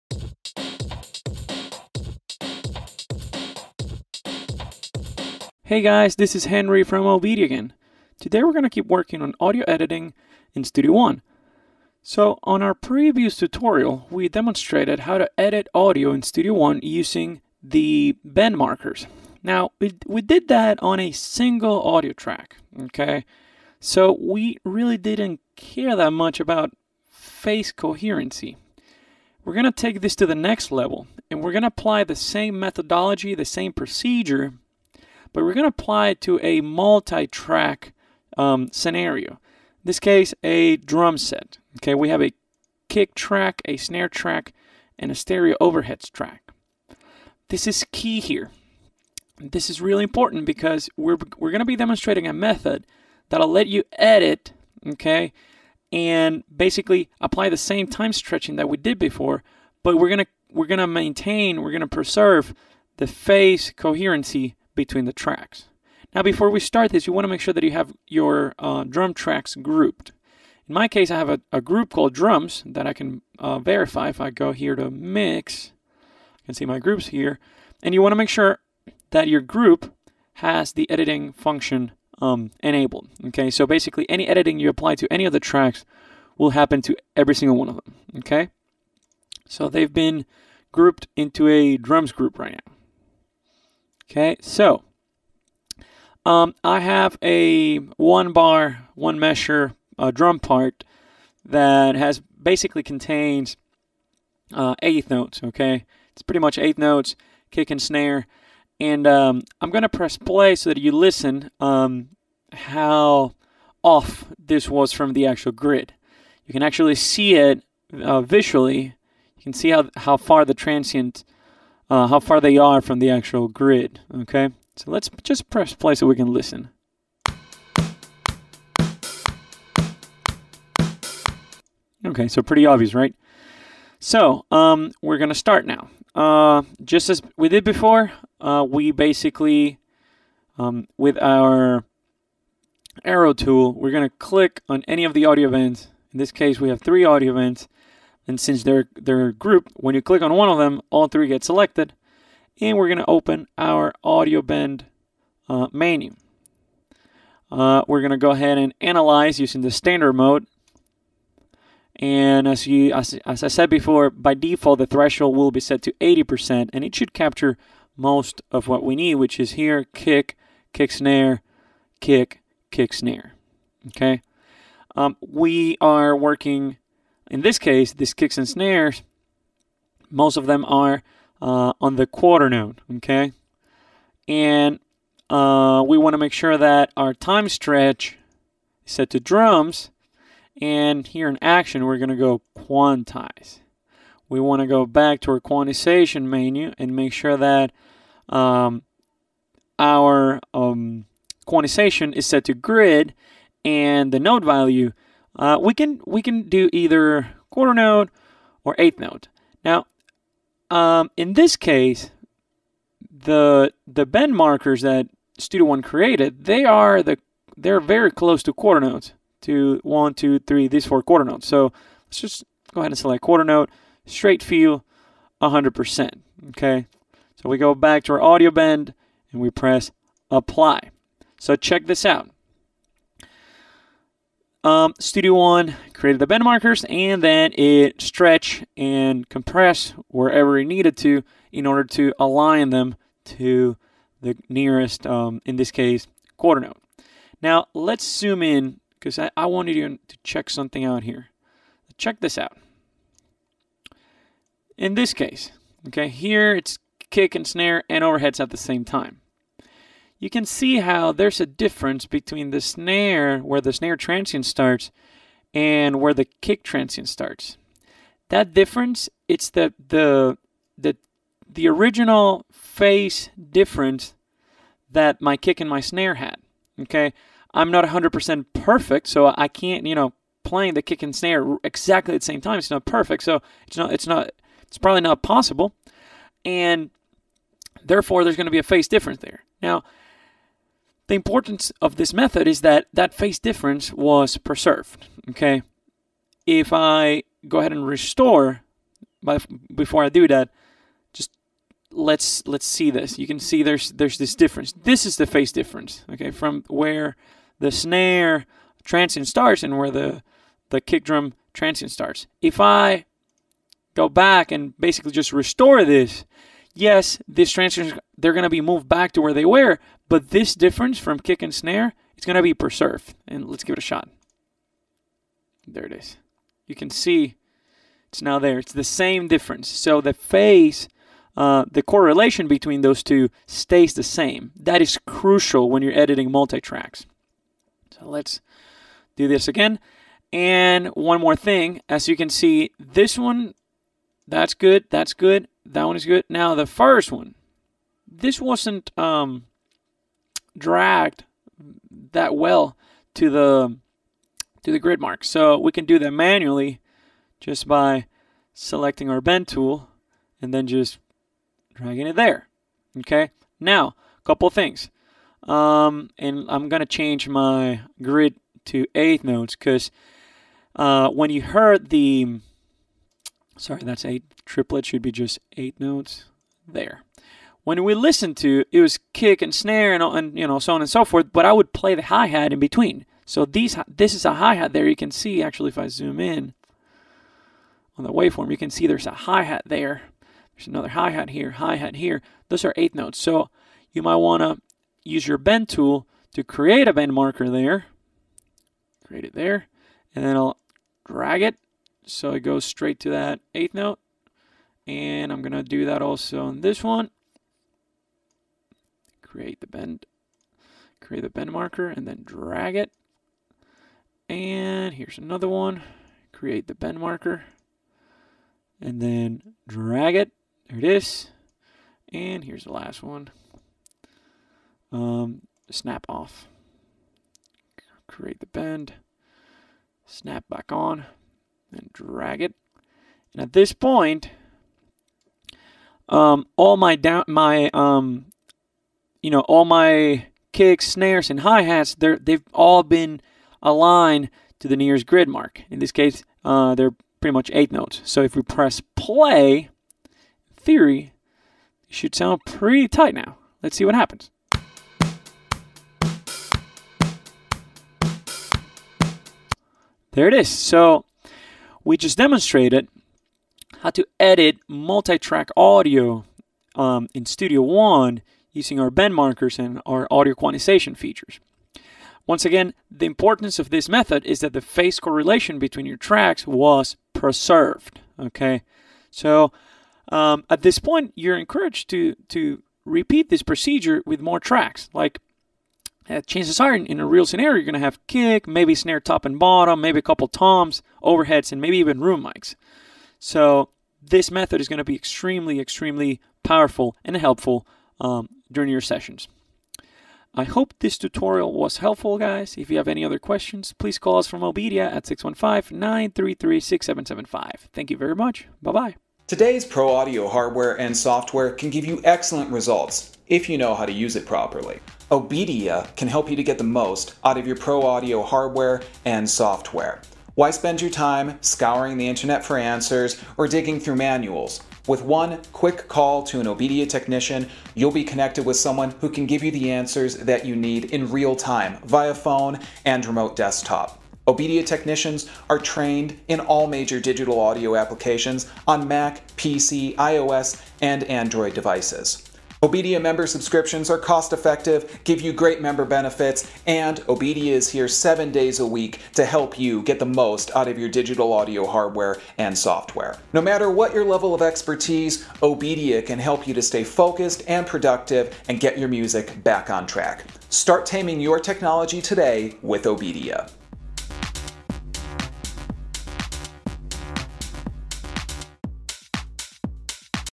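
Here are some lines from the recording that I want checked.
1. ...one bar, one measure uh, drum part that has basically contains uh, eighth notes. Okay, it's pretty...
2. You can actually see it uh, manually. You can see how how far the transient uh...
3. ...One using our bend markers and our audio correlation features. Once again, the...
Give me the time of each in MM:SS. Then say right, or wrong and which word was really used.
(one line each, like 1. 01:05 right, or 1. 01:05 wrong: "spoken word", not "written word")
1. 01:37 right
2. 01:56 wrong: "visually", not "manually"
3. 07:47 wrong: "quantization", not "correlation".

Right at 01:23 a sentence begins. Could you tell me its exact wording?
Okay, so basically any editing you apply to any of the tracks will happen to every single one of them.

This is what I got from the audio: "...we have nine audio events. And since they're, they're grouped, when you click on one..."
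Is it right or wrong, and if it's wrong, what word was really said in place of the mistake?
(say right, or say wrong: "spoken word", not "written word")
wrong: "three", not "nine".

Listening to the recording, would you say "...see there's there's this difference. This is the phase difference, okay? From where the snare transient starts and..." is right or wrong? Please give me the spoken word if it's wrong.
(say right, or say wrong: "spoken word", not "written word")
right.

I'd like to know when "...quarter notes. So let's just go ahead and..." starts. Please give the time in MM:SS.
03:41.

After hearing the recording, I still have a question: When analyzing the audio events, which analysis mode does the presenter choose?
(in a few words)
Standard.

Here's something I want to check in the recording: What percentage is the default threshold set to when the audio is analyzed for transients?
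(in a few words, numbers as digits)
80%.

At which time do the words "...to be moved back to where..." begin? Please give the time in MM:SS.
05:18.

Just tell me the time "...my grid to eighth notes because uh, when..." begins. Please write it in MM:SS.
06:07.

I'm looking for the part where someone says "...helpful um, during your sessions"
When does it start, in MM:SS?
08:17.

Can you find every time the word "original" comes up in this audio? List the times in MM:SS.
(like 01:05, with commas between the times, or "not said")
04:31.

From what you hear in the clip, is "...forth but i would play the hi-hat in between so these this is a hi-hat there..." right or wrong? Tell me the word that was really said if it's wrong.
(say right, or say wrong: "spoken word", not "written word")
right.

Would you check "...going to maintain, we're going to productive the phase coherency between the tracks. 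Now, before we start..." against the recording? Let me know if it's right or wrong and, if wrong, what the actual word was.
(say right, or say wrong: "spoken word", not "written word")
wrong: "preserve", not "productive".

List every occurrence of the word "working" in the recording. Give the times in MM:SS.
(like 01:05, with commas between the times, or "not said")
00:08, 02:56.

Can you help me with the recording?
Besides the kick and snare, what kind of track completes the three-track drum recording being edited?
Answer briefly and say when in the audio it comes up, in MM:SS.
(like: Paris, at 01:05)
Stereo overheads, at 00:45.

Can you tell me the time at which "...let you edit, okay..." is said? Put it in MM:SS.
00:53.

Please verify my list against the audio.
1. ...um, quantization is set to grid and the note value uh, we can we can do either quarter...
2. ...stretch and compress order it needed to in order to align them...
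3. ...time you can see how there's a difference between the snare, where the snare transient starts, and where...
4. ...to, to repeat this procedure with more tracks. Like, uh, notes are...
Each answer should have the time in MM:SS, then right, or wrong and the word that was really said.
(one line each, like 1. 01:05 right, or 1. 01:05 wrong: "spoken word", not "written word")
1. 03:20 right
2. 03:57 wrong: "wherever", not "order"
3. 04:18 right
4. 08:01 wrong: "chances", not "notes".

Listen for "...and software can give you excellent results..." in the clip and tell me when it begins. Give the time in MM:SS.
08:30.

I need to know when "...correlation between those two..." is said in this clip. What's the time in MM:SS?
05:31.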